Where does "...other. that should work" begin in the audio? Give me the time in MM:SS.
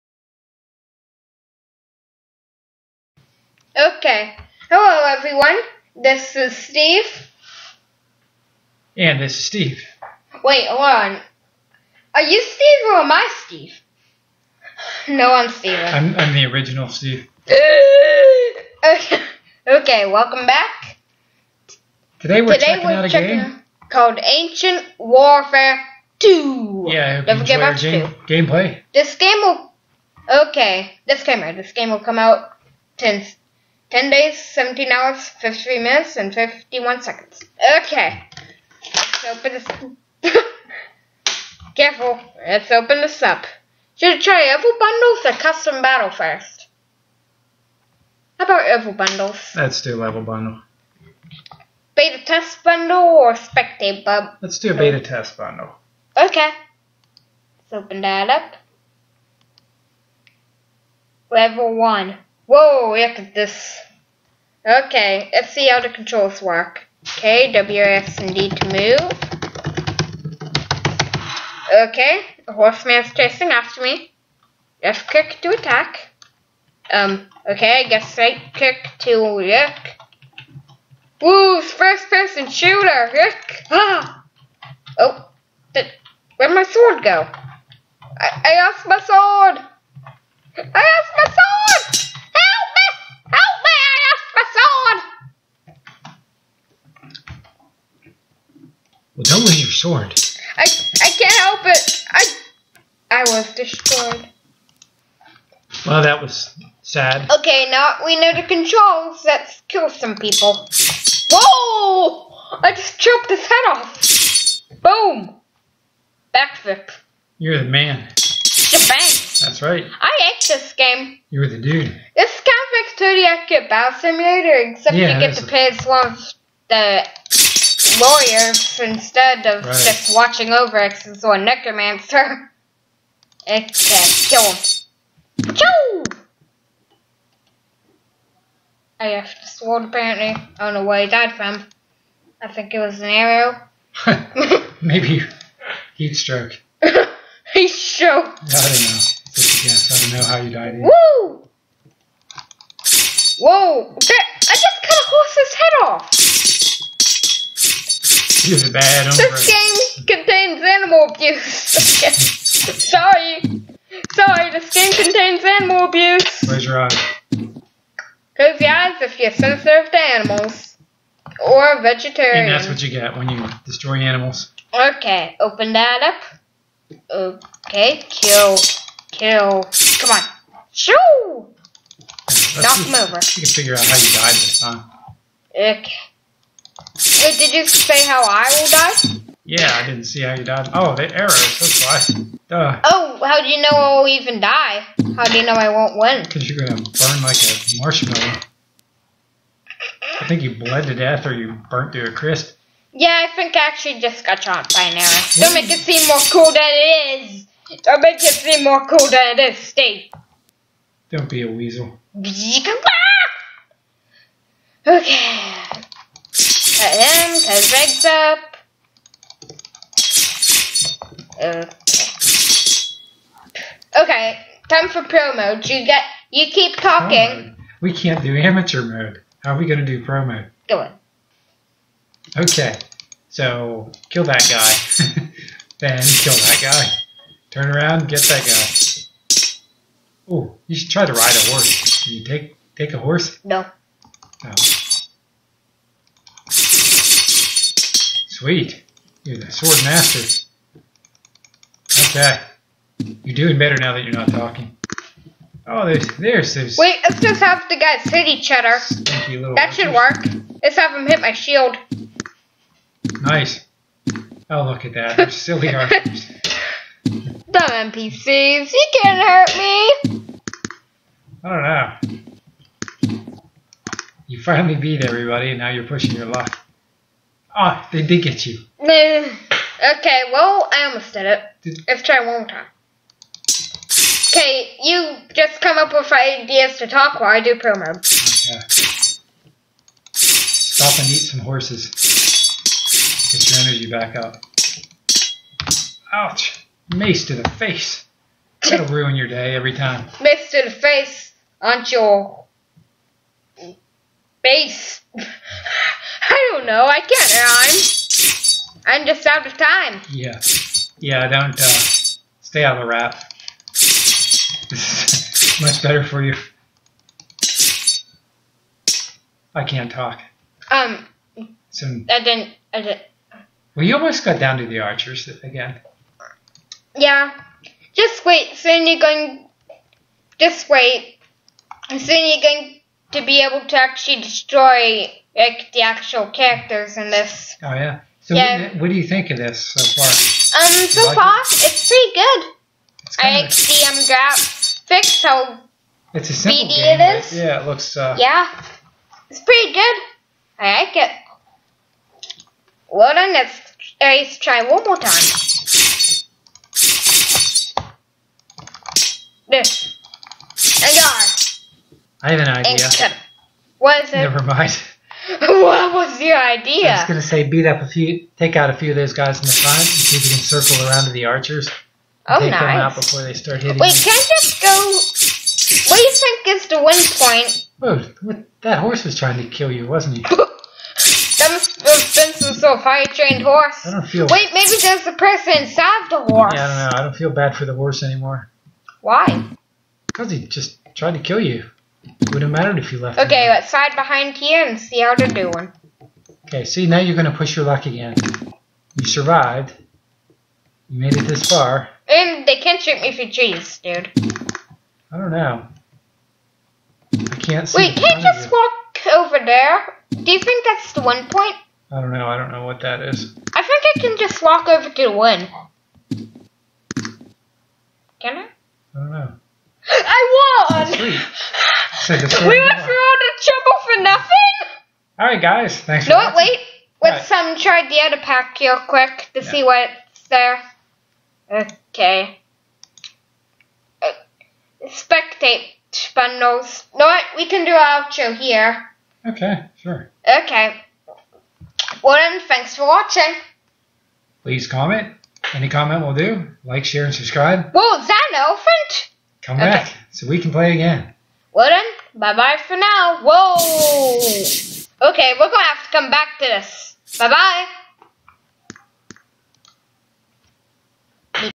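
04:18.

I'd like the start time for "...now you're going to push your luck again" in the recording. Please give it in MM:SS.
06:36.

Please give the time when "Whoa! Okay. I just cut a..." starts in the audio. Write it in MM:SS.
02:33.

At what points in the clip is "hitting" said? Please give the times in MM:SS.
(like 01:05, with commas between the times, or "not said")
06:13.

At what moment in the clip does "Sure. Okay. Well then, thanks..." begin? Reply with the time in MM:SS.
07:19.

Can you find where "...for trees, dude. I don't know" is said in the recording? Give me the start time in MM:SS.
06:43.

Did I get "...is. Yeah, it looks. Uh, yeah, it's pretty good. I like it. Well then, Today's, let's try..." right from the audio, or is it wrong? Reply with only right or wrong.
wrong.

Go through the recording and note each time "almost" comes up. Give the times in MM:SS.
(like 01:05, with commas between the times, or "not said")
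04:40, 05:23.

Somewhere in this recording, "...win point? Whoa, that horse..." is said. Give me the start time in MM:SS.
06:16.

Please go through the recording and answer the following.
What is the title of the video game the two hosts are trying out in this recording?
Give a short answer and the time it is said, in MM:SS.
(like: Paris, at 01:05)
Ancient Warfare 2, at 00:24.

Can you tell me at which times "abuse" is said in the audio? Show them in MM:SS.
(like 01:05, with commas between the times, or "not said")
02:41, 02:45.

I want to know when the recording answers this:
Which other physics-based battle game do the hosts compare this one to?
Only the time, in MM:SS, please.
02:02.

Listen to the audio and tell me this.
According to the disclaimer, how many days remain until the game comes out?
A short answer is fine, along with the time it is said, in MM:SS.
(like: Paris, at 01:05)
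10 days, at 00:33.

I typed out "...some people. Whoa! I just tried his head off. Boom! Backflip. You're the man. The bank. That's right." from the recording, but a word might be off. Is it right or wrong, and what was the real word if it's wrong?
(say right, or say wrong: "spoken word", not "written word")
wrong: "chopped", not "tried".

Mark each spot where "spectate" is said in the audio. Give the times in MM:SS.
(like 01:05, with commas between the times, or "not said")
00:53, 07:14.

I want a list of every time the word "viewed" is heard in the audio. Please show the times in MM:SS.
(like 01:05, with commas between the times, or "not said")
not said.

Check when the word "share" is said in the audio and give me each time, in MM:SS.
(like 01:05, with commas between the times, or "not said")
07:26.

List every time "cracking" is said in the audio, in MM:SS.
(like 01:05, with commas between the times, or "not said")
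not said.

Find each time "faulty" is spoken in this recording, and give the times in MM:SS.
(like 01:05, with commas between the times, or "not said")
not said.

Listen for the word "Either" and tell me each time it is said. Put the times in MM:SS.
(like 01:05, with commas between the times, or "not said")
02:30.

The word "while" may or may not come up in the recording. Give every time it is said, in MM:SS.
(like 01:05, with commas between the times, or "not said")
04:47.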